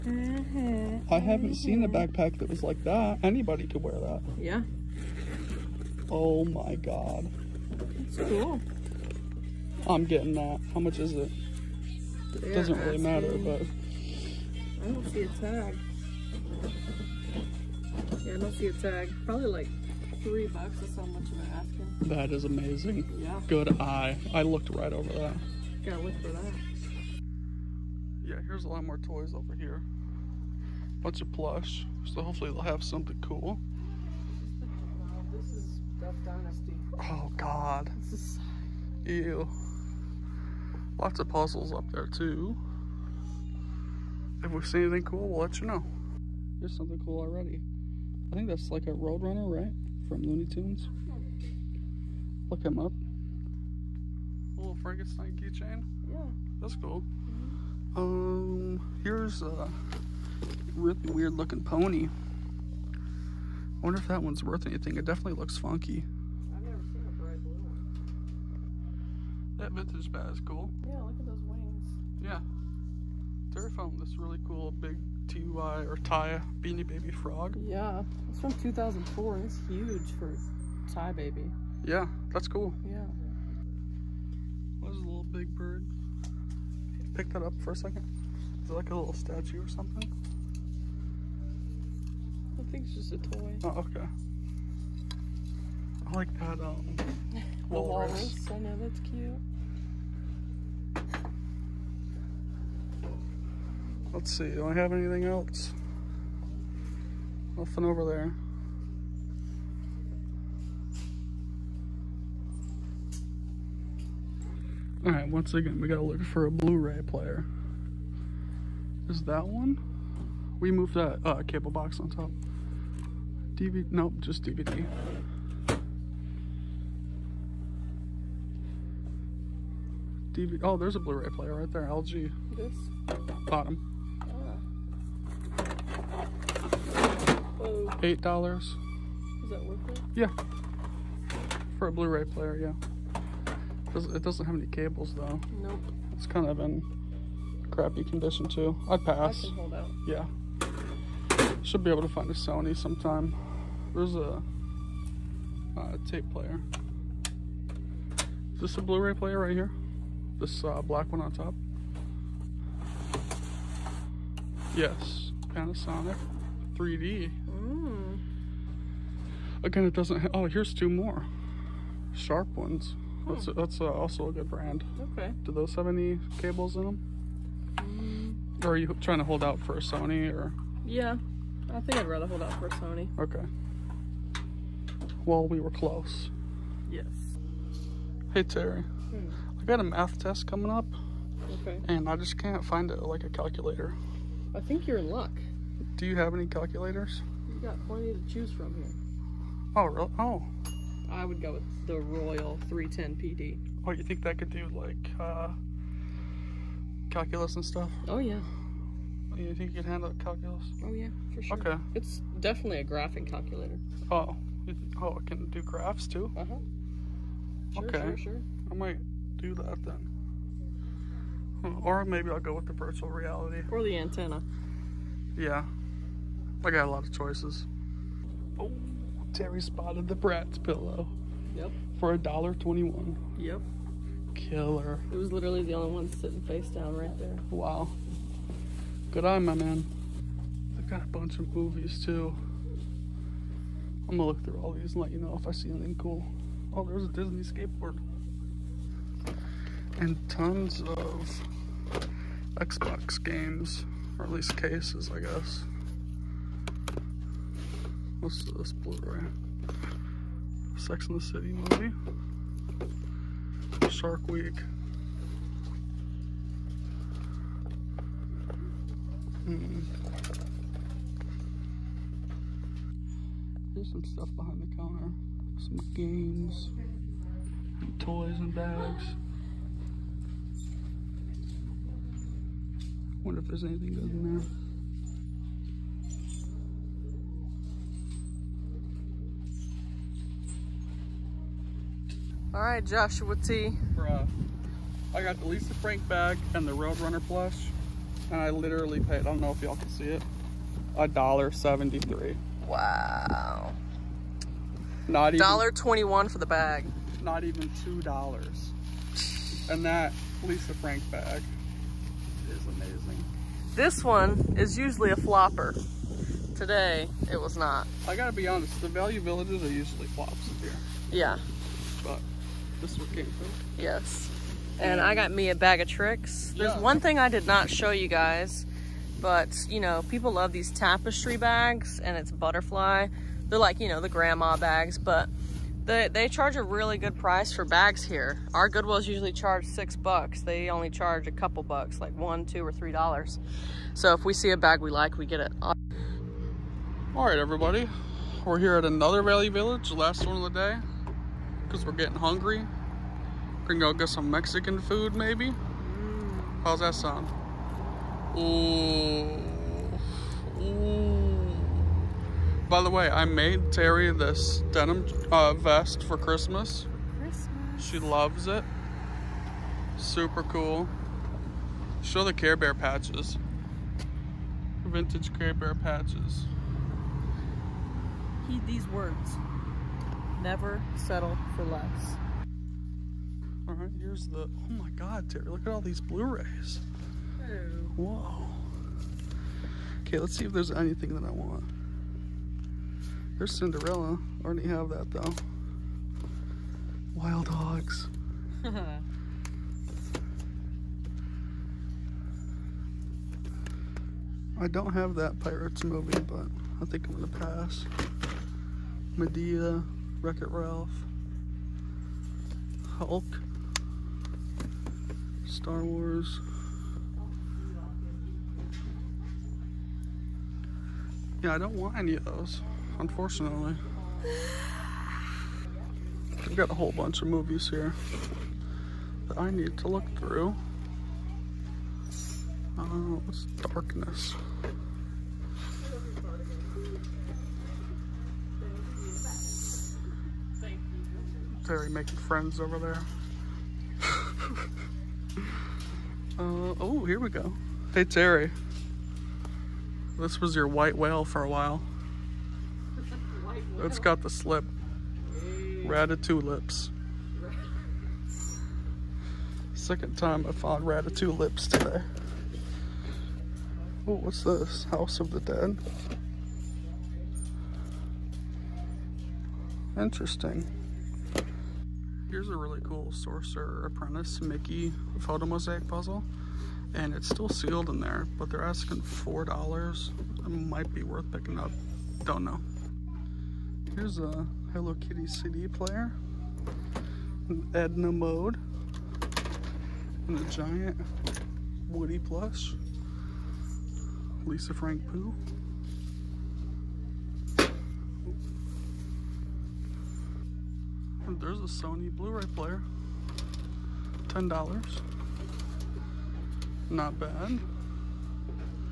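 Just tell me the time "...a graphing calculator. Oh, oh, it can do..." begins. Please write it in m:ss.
3:32.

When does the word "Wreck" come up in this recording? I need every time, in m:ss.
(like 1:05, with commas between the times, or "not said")
6:50.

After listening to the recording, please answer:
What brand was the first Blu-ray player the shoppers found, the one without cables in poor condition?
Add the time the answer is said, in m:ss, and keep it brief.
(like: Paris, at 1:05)
LG, at 2:11.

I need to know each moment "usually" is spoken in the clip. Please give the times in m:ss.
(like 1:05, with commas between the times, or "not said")
5:14, 5:19, 5:39.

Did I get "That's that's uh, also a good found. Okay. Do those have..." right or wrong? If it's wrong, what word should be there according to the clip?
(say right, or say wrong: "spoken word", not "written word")
wrong: "brand", not "found".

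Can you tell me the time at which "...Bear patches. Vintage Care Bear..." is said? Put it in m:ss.
6:12.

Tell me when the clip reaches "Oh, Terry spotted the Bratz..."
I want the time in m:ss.
3:48.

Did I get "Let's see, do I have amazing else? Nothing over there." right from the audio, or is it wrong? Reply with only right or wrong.
wrong.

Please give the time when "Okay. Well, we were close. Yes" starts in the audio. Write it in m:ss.
3:03.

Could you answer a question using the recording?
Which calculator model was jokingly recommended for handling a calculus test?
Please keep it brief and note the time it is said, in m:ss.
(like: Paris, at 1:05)
Royal 310 PD, at 3:21.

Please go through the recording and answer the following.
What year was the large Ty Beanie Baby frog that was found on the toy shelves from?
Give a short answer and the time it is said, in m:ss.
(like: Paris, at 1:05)
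2004, at 1:18.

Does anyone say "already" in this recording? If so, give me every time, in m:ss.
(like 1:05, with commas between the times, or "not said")
0:47, 6:34.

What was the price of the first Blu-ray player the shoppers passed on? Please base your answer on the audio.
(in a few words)
$8.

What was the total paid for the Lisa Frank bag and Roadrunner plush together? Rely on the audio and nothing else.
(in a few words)
$1.73.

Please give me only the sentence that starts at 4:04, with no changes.
I'm gonna look through all these and let you know if I see anything cool.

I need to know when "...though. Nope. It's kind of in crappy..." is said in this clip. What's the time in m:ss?
2:25.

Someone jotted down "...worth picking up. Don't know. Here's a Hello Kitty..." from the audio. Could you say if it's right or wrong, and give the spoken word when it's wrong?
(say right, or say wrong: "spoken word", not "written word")
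right.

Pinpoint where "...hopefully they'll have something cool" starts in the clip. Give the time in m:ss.
0:32.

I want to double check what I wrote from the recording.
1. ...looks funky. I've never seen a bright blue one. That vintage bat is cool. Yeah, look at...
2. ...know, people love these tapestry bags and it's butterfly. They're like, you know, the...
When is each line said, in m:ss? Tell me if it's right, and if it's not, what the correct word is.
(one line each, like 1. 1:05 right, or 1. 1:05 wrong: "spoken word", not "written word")
1. 1:05 right
2. 5:29 right.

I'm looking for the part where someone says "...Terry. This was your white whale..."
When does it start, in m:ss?
7:28.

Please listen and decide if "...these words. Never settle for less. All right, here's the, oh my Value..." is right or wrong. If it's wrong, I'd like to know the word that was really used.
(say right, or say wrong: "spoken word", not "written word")
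wrong: "God", not "Value".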